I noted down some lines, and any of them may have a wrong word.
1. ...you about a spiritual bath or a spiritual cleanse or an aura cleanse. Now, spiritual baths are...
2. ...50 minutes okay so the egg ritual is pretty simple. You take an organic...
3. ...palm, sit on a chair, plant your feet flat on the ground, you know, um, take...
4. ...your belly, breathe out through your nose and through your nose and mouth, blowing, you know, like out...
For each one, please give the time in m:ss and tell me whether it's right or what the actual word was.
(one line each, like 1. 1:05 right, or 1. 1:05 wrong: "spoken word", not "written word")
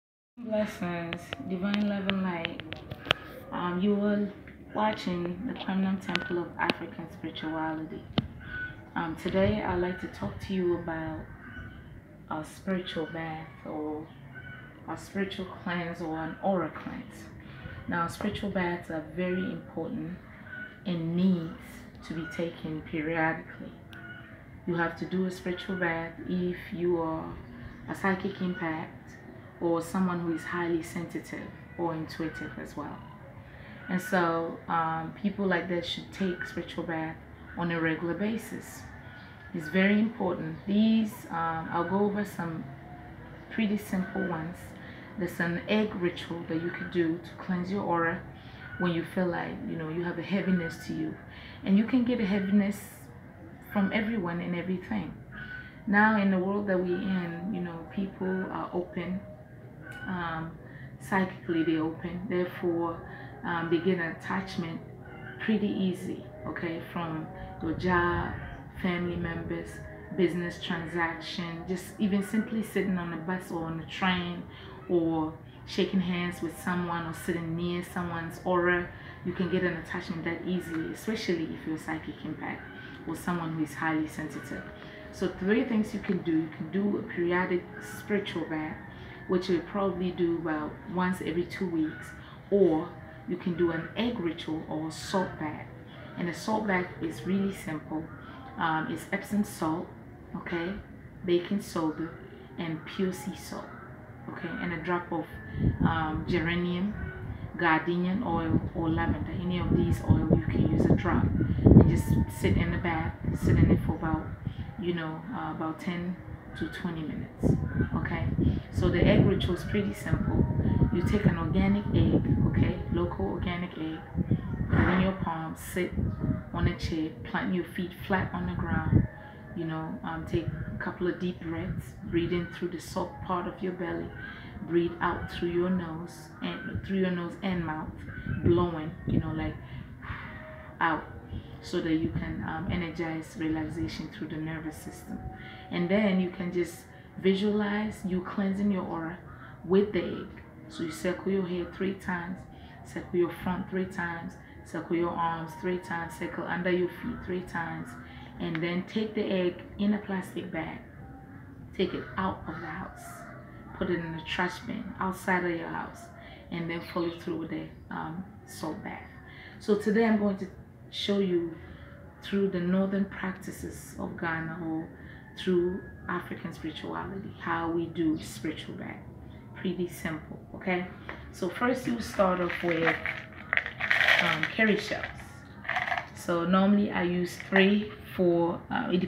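1. 0:10 right
2. 1:56 wrong: "20", not "50"
3. 2:05 right
4. 2:13 right.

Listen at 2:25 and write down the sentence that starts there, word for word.
And then you can just Visualize you cleansing your aura with the egg.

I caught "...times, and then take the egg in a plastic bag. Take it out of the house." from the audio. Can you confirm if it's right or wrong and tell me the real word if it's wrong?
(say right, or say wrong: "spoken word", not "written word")
right.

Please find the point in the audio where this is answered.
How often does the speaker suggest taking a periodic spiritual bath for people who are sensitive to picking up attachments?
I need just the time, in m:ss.
1:30.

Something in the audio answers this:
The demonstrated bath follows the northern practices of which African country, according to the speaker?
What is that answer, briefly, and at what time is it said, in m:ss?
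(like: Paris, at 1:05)
Ghana, at 2:54.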